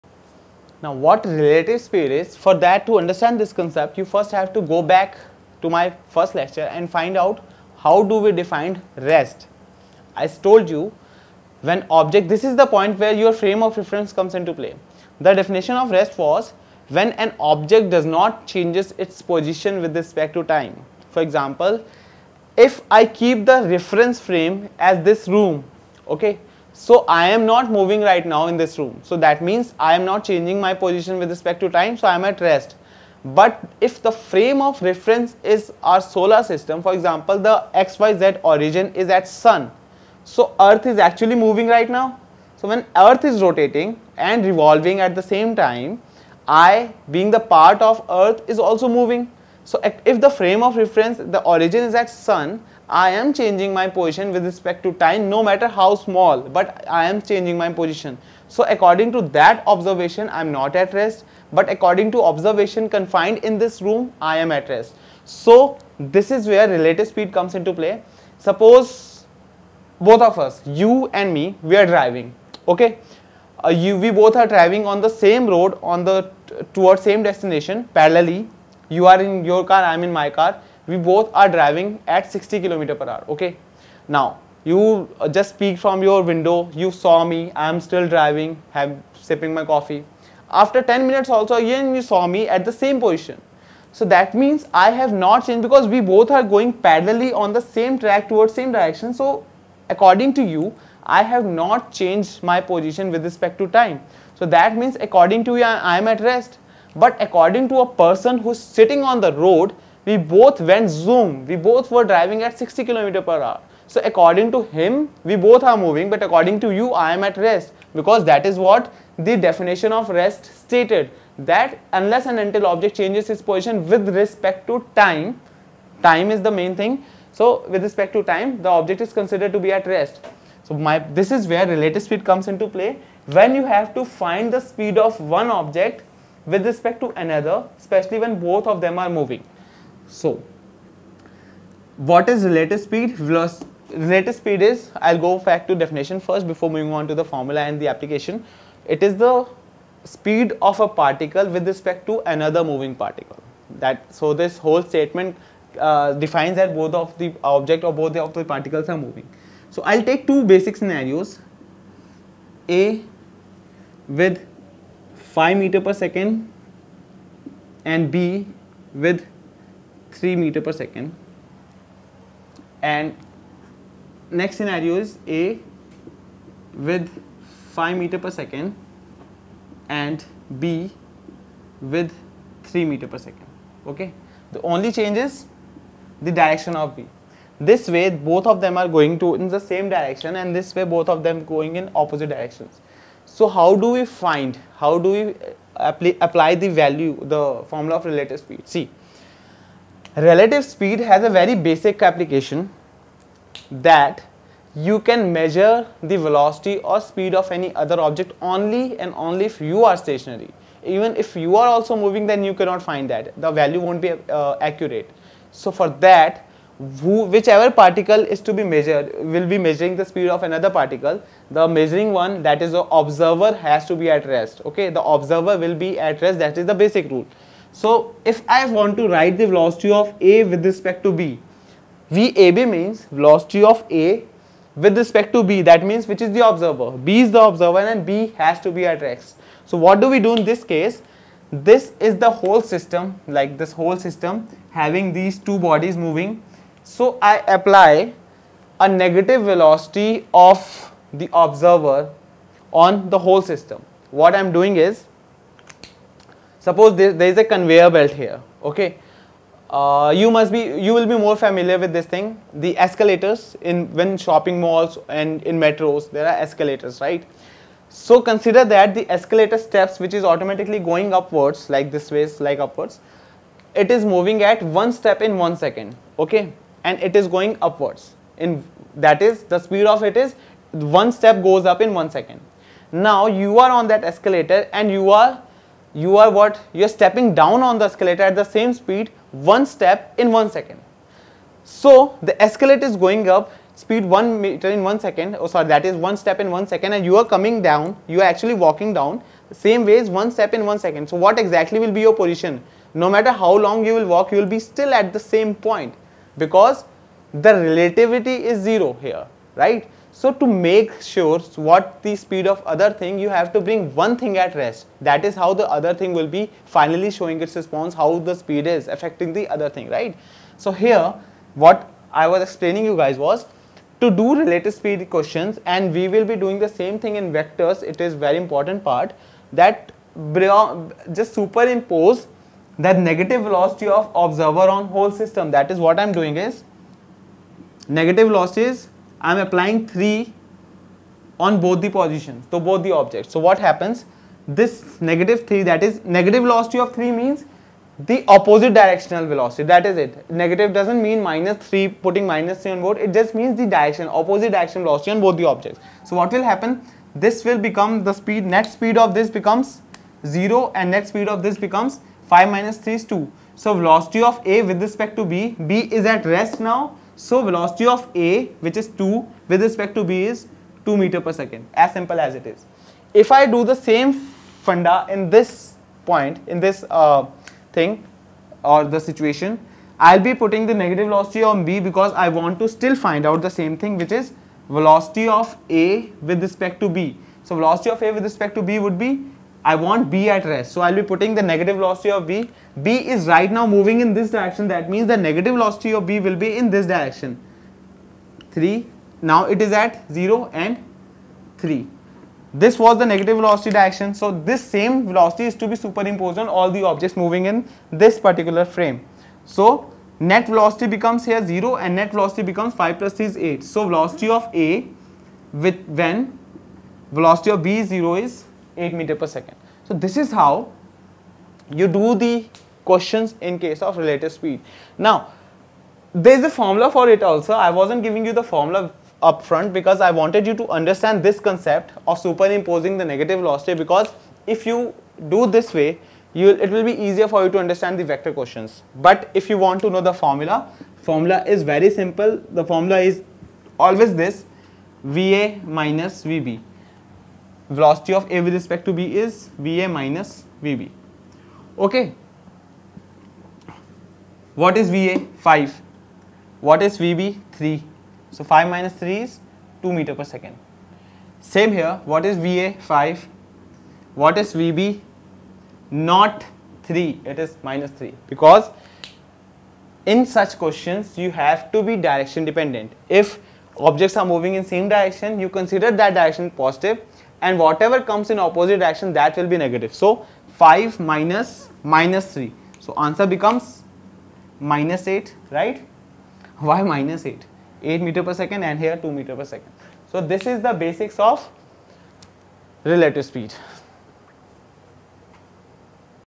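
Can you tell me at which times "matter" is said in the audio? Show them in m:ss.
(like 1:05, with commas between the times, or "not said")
0:55, 5:03.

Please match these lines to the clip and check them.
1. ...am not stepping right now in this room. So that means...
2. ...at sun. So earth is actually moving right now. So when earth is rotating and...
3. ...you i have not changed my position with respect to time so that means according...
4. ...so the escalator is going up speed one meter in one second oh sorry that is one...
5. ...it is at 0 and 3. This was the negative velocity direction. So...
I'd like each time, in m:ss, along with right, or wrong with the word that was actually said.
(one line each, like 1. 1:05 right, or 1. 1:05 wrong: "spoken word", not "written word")
1. 0:27 wrong: "moving", not "stepping"
2. 0:39 right
3. 1:40 right
4. 4:51 right
5. 6:39 right.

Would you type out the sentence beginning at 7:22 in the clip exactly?
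The formula is always this, VA minus VB velocity of A with respect to B is VA minus VB.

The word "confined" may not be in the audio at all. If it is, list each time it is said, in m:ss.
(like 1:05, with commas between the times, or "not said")
1:02.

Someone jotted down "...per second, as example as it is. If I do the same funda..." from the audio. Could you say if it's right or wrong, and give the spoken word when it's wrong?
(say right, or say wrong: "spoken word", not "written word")
wrong: "simple", not "example".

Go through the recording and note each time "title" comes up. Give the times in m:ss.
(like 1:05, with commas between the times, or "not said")
not said.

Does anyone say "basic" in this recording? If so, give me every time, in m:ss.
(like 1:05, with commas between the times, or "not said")
2:40, 3:21, 3:46, 8:10.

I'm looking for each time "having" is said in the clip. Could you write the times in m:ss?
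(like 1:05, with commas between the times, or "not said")
4:04.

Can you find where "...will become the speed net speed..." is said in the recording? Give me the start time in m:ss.
5:57.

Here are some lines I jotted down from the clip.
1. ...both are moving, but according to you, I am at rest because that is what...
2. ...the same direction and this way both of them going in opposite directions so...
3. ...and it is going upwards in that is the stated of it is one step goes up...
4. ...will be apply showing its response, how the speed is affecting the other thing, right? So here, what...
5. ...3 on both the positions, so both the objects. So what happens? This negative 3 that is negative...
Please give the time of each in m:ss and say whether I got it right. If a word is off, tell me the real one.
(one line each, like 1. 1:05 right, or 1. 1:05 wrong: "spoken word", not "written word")
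1. 1:55 right
2. 3:09 right
3. 4:36 wrong: "speed", not "stated"
4. 5:16 wrong: "finally", not "apply"
5. 5:39 right.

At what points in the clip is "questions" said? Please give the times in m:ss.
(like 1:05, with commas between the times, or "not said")
5:25, 7:02, 7:18, 7:50.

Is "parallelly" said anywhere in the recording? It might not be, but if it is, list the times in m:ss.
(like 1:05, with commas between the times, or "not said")
1:17, 1:36.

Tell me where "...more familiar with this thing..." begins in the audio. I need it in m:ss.
4:21.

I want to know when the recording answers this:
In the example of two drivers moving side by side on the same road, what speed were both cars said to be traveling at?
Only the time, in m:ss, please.
1:22.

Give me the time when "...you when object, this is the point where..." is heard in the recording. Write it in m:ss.
0:10.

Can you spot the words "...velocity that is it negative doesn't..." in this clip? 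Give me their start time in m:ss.
5:49.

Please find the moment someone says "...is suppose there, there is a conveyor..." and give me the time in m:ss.
4:14.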